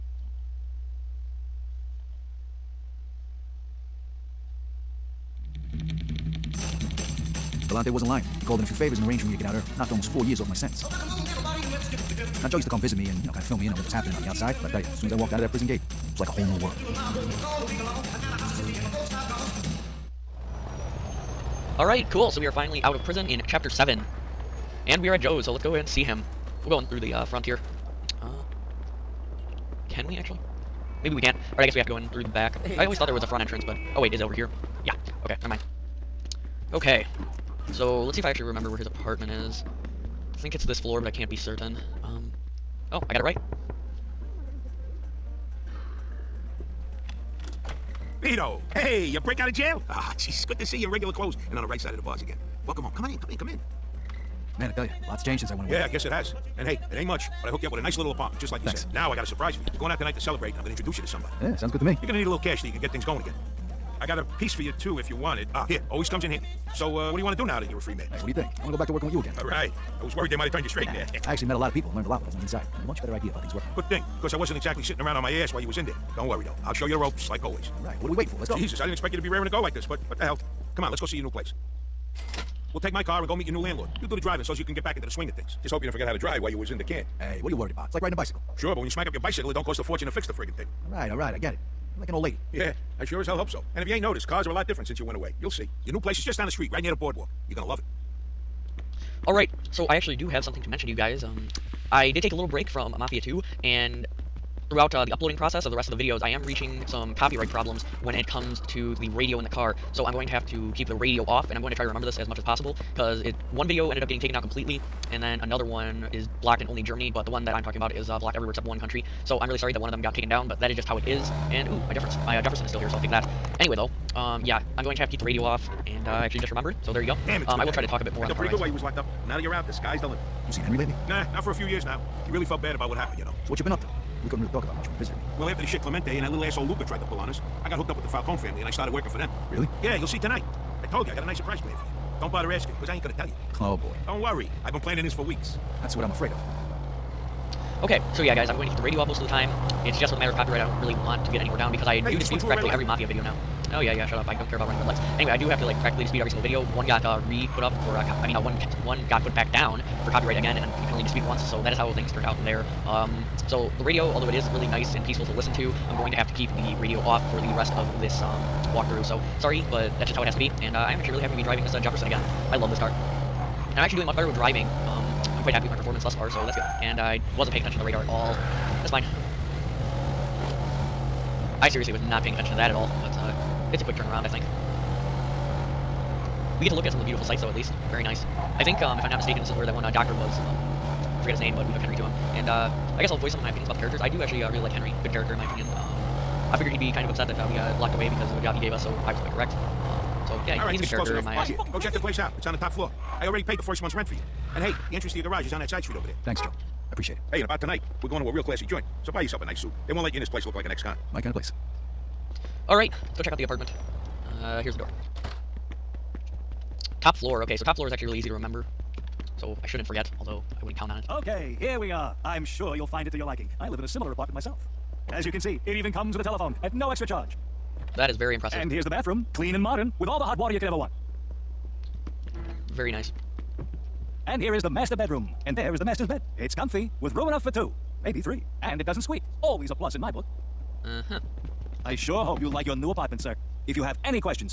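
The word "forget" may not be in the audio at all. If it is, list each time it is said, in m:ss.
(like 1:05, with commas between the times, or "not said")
1:25, 3:11, 3:39.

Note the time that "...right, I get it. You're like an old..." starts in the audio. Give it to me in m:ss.
1:31.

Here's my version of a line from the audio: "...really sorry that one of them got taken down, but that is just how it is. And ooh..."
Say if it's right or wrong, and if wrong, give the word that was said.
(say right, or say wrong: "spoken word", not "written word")
right.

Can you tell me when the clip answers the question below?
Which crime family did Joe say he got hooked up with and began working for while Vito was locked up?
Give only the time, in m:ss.
2:18.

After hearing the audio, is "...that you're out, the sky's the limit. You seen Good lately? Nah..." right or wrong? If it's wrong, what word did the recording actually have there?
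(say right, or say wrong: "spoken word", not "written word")
wrong: "Henry", not "Good".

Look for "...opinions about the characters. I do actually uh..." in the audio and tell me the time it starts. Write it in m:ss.
3:13.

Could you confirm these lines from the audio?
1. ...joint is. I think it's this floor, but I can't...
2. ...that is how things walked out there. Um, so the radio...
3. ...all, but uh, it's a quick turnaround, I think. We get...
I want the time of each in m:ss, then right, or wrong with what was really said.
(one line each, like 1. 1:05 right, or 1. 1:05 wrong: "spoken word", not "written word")
1. 0:38 wrong: "apartment", not "joint"
2. 2:41 wrong: "turned", not "walked"
3. 3:02 right.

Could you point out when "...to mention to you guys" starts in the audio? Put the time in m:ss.
1:40.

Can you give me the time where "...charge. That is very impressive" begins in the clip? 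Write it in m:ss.
3:47.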